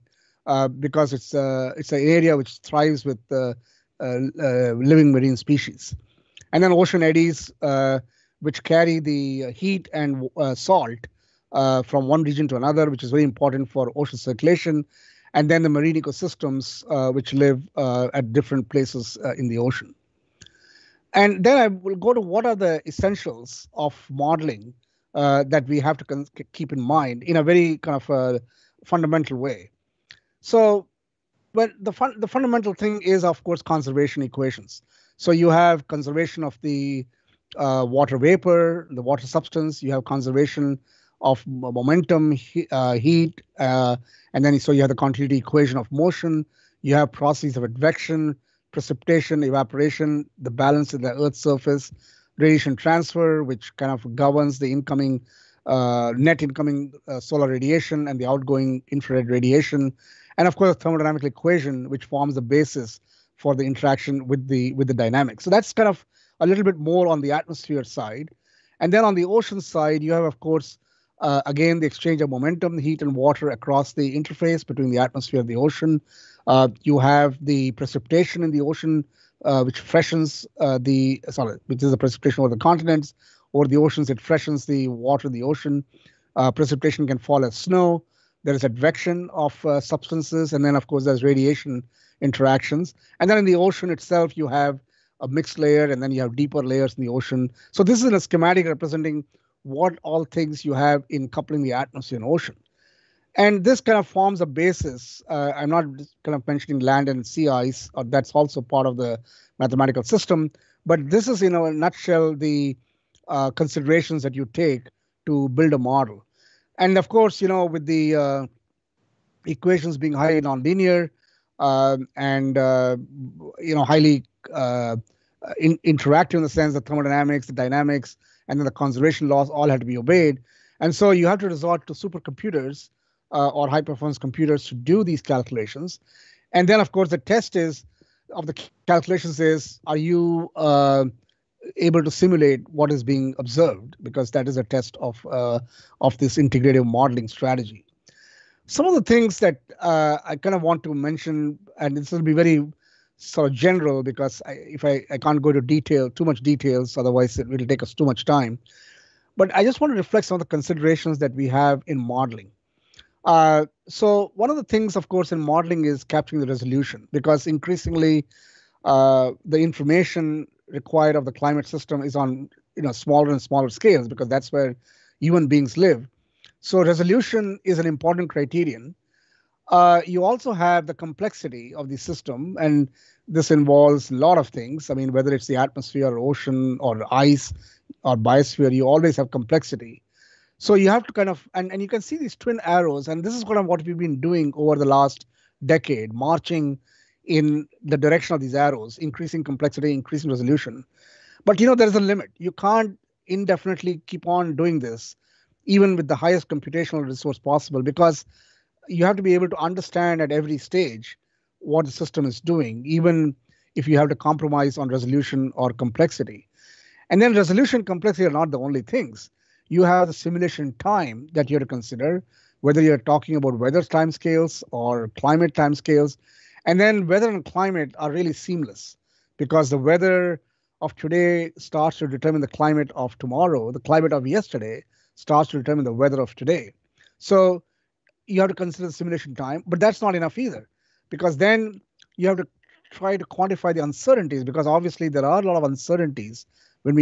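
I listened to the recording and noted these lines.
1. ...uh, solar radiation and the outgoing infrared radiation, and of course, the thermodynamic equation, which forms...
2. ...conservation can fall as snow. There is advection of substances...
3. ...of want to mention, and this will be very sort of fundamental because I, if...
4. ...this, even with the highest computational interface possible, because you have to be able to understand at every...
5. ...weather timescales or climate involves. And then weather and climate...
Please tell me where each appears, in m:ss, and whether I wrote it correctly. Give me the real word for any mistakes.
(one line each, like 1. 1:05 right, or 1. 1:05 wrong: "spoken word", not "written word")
1. 0:57 right
2. 1:26 wrong: "precipitation", not "conservation"
3. 2:30 wrong: "general", not "fundamental"
4. 3:24 wrong: "resource", not "interface"
5. 3:43 wrong: "timescales", not "involves".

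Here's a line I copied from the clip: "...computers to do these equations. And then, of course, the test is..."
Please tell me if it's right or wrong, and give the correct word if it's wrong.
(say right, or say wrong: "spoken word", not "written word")
wrong: "calculations", not "equations".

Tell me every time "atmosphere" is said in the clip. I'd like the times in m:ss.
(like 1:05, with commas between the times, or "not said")
1:07, 1:14, 1:41, 3:05.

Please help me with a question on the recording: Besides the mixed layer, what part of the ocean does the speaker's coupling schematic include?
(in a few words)
Deeper layers.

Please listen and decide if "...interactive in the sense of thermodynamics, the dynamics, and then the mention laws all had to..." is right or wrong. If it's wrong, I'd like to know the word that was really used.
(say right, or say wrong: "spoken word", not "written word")
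wrong: "conservation", not "mention".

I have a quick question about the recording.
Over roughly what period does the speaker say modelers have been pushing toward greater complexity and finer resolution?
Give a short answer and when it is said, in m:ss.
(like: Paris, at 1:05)
The last decade, at 3:14.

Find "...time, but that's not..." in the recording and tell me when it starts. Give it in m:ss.
3:59.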